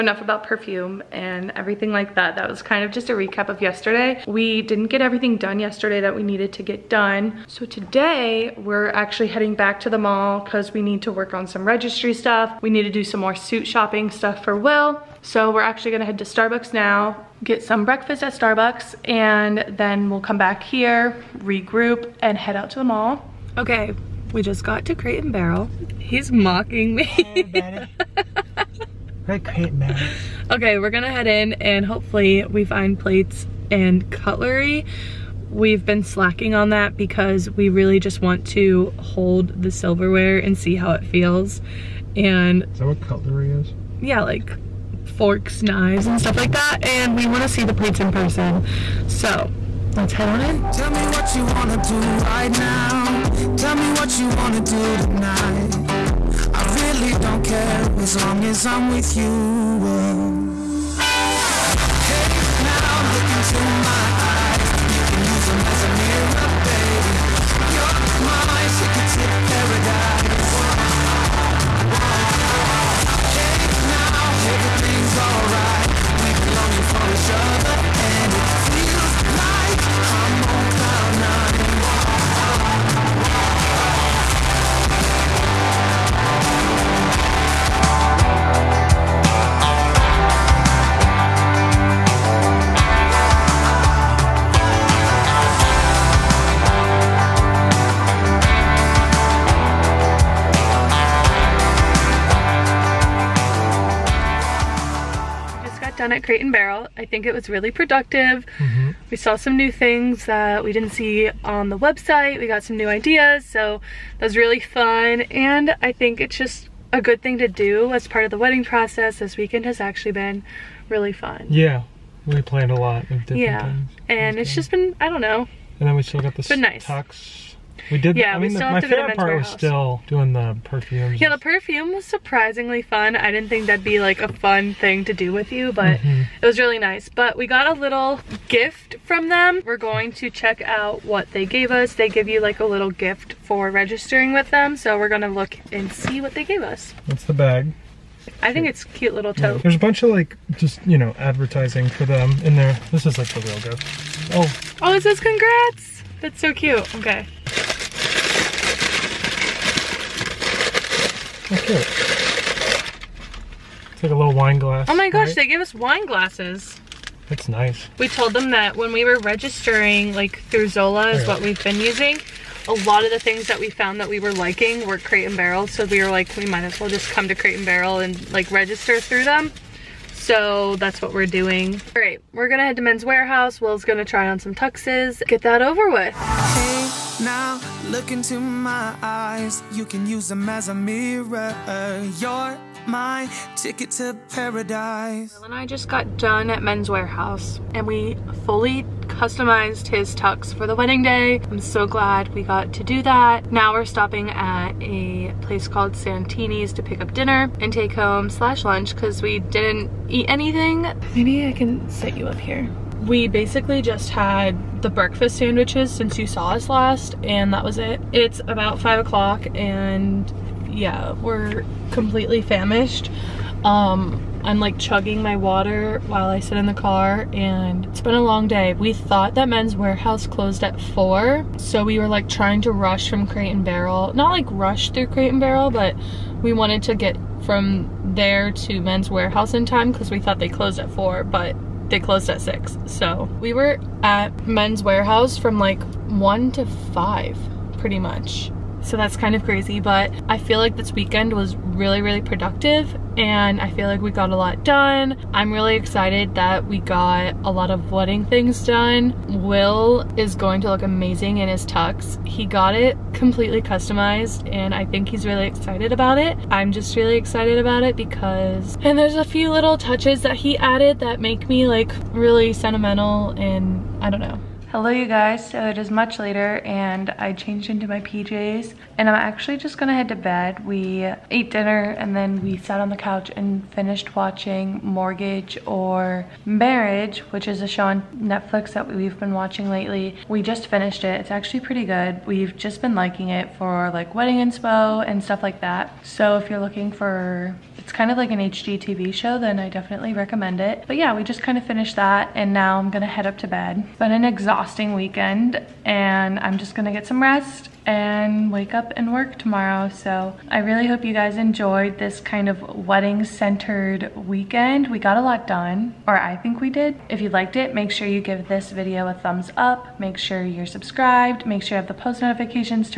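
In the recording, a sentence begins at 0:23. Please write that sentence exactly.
Okay, we just got to Crate and Barrel.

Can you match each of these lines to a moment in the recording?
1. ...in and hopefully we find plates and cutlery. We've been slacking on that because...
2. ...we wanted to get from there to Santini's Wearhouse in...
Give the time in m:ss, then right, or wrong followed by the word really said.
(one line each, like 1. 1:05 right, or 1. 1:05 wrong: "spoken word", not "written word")
1. 0:31 right
2. 3:56 wrong: "Men", not "Santini".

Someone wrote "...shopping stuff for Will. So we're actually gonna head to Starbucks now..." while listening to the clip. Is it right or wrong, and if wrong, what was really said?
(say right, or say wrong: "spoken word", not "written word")
right.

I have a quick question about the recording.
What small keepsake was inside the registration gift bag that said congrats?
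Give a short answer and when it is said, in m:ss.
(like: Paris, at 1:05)
wine glass, at 2:44.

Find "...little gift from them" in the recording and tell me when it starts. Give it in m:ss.
2:17.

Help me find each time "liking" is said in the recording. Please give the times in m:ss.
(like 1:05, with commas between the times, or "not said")
2:54, 4:52.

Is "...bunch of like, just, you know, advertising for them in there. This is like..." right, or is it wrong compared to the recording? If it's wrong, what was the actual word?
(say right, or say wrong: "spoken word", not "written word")
right.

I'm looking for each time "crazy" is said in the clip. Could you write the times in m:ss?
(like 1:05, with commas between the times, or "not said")
4:09.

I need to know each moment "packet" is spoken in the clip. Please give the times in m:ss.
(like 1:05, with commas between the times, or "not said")
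not said.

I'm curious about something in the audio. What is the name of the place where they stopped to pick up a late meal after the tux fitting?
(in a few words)
Santini's.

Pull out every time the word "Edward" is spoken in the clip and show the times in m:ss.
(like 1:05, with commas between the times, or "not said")
not said.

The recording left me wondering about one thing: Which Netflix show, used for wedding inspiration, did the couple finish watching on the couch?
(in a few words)
Mortgage or Marriage.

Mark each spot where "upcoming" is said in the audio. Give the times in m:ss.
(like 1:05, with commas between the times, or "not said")
not said.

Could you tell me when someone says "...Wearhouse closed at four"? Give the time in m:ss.
3:49.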